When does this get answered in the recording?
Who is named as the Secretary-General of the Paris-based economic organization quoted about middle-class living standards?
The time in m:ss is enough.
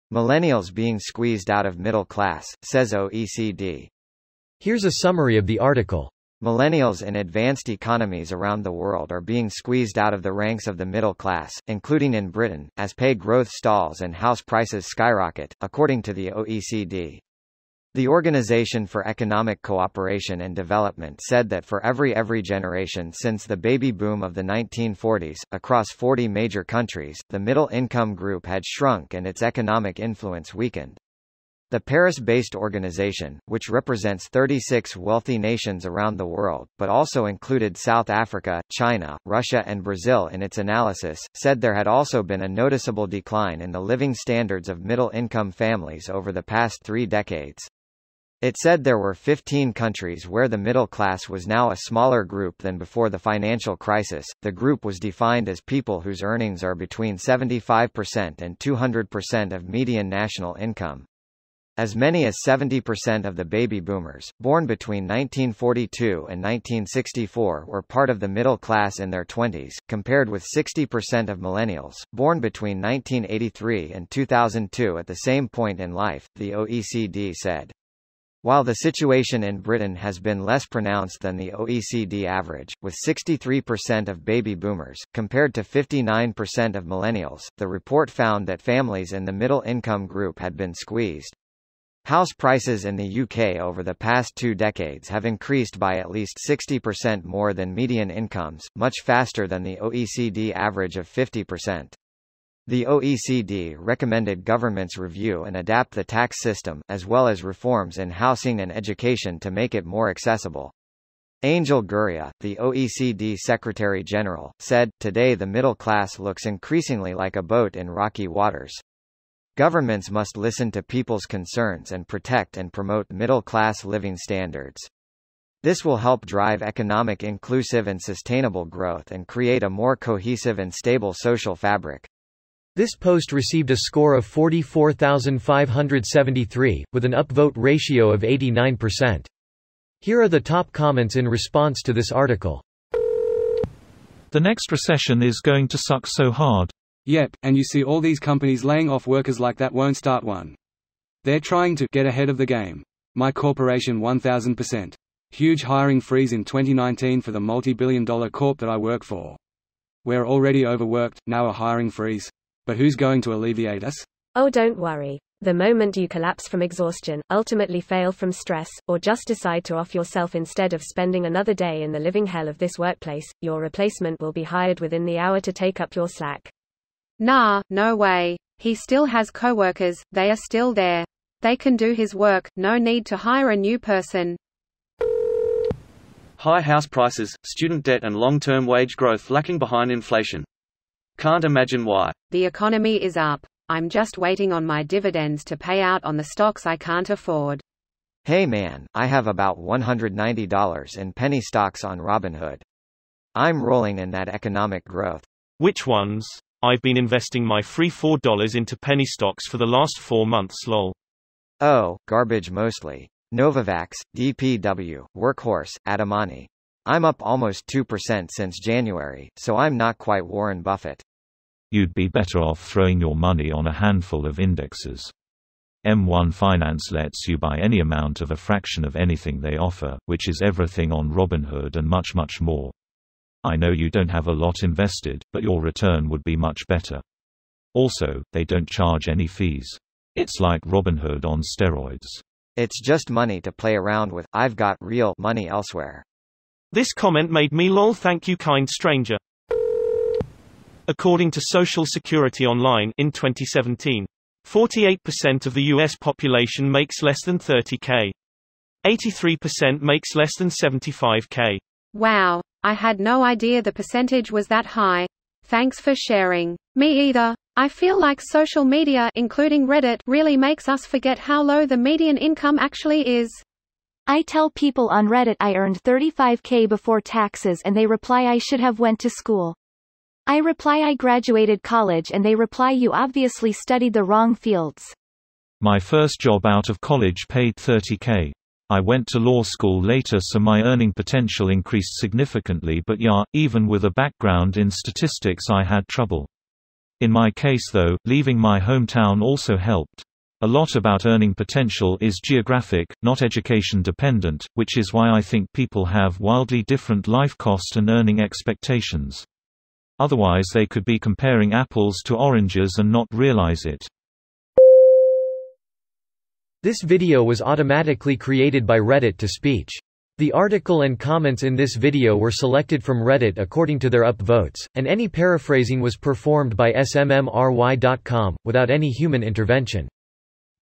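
1:51.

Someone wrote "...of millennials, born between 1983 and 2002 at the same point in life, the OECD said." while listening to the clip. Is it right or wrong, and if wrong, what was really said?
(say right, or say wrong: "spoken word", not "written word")
right.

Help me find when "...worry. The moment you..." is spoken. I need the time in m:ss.
2:44.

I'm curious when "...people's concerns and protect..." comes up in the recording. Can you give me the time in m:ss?
2:00.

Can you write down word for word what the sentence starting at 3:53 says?
I know you don't have a lot invested, but your return would be much better.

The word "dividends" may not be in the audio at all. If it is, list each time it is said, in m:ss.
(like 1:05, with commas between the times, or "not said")
3:14.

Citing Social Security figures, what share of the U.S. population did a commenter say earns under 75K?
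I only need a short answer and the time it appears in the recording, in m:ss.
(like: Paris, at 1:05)
83%, at 4:18.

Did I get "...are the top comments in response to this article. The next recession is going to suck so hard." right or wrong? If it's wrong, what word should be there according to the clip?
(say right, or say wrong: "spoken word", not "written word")
right.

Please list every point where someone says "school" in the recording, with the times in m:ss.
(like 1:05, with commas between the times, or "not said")
4:39, 4:49.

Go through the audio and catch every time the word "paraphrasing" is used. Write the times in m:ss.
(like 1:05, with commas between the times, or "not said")
5:25.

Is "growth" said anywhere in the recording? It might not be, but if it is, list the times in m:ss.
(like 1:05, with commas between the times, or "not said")
0:13, 2:08, 3:08, 3:24.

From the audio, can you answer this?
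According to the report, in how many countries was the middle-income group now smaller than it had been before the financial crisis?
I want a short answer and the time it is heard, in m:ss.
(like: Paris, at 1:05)
15, at 0:49.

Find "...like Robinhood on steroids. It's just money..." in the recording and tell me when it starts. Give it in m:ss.
4:00.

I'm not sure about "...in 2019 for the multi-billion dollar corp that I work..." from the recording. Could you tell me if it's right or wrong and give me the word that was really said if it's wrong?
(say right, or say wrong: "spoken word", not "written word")
right.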